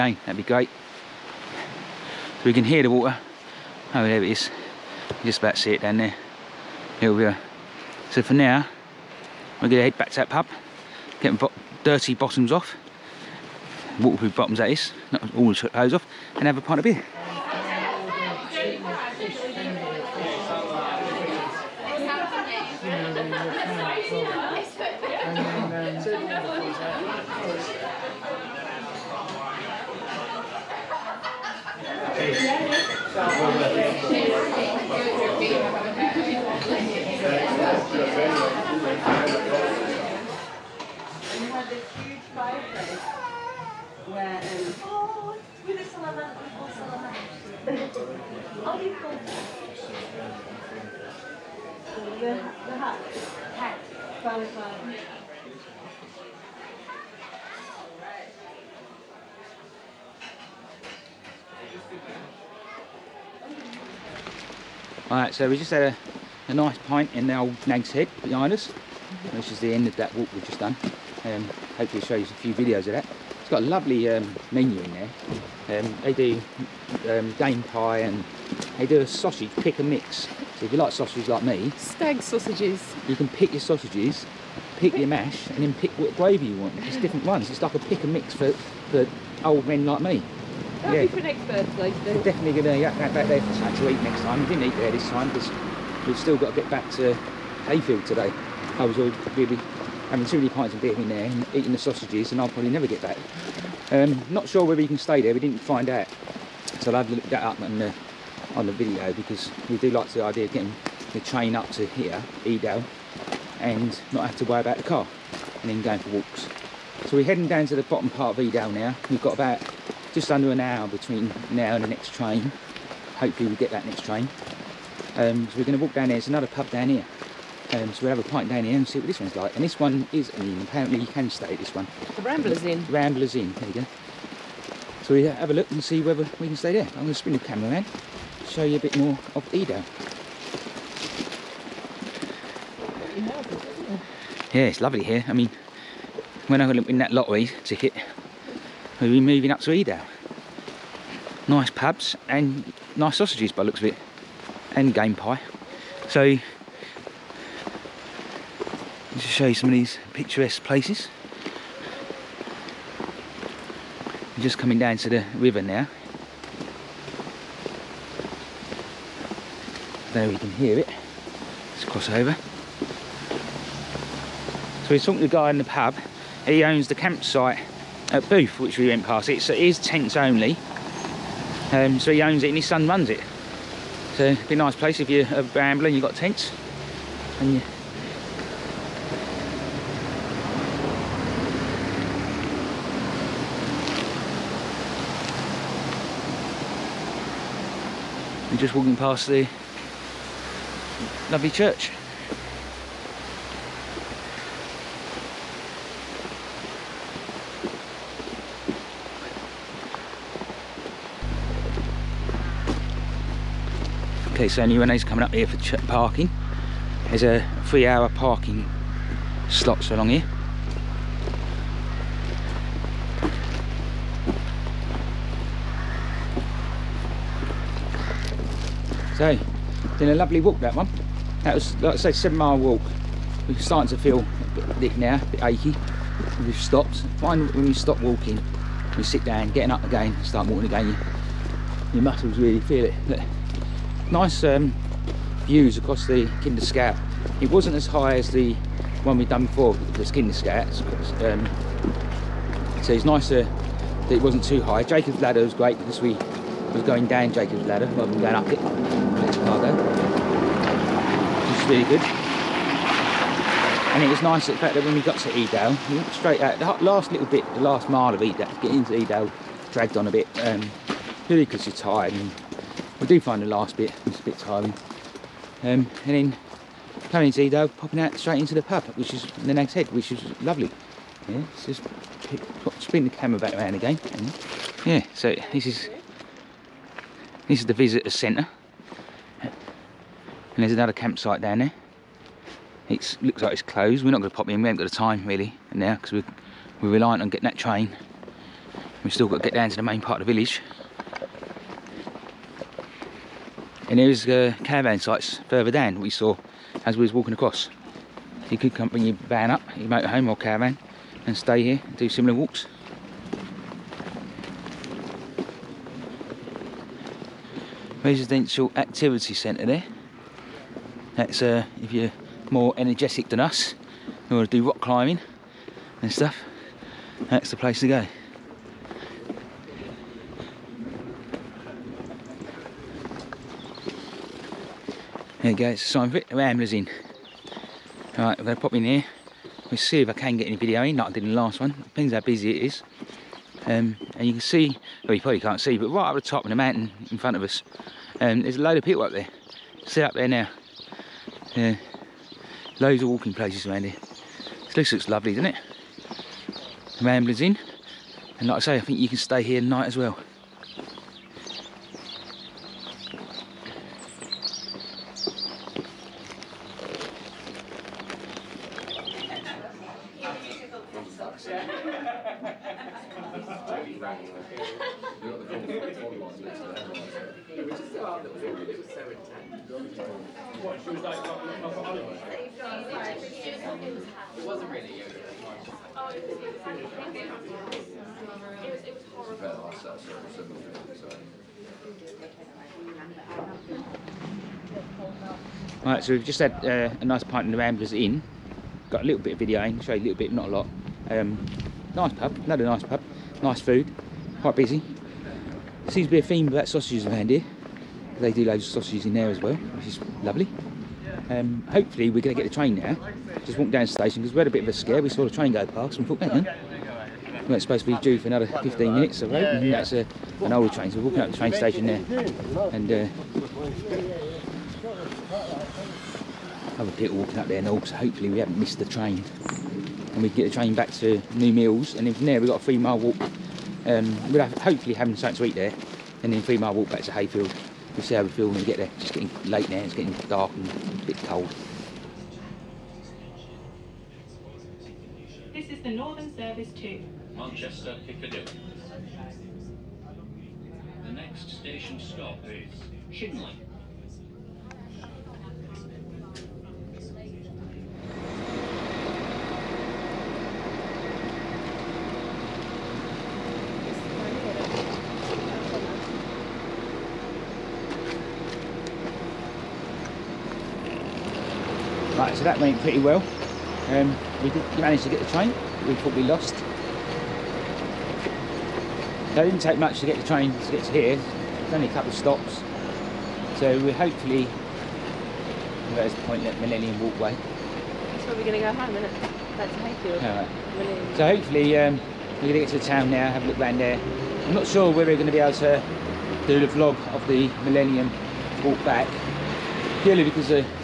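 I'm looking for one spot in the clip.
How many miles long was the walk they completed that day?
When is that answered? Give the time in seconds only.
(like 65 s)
232 s.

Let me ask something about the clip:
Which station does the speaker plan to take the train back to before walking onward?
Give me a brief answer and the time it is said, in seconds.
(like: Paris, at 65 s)
New Mills, at 431 s.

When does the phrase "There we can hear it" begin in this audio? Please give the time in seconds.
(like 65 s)
170 s.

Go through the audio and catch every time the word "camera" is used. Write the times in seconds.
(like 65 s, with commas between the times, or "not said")
137 s, 283 s.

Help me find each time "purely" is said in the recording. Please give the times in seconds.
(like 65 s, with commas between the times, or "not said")
271 s, 500 s.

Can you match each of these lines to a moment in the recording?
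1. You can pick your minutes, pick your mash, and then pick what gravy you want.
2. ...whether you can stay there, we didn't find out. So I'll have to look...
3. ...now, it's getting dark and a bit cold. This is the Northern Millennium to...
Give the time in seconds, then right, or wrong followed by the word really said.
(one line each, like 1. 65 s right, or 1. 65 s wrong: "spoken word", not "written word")
1. 83 s wrong: "sausages", not "minutes"
2. 104 s right
3. 439 s wrong: "Service", not "Millennium".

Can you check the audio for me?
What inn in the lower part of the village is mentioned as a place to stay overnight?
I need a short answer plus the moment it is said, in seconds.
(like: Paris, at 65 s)
The Rambler's Inn, at 132 s.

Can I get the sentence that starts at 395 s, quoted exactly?
Alright, so we've just had uh, a nice pint in the Ramblers Inn.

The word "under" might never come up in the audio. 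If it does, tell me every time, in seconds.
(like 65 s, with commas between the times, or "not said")
120 s.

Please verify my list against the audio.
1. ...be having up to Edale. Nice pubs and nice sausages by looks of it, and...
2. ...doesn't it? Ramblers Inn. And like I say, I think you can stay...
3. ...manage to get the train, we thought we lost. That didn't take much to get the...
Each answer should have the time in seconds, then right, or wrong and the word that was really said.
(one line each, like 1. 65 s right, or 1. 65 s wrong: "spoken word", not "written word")
1. 149 s wrong: "moving", not "having"
2. 355 s right
3. 474 s right.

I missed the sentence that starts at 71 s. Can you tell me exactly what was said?
Um, hopefully show you a few videos of that.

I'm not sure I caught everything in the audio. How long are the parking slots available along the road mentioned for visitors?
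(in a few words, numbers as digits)
3 hours.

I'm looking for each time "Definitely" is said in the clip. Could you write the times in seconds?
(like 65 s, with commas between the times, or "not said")
92 s.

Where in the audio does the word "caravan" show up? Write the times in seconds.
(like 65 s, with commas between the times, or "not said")
304 s, 310 s.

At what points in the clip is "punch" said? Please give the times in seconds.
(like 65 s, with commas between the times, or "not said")
not said.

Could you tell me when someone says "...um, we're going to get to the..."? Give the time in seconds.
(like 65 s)
491 s.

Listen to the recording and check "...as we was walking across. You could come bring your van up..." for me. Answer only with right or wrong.
right.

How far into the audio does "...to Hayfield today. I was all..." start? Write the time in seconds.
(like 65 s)
96 s.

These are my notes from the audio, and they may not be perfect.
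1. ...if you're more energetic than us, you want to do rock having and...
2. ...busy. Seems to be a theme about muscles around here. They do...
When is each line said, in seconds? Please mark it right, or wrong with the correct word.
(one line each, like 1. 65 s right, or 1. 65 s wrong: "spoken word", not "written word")
1. 321 s wrong: "climbing", not "having"
2. 404 s wrong: "sausages", not "muscles".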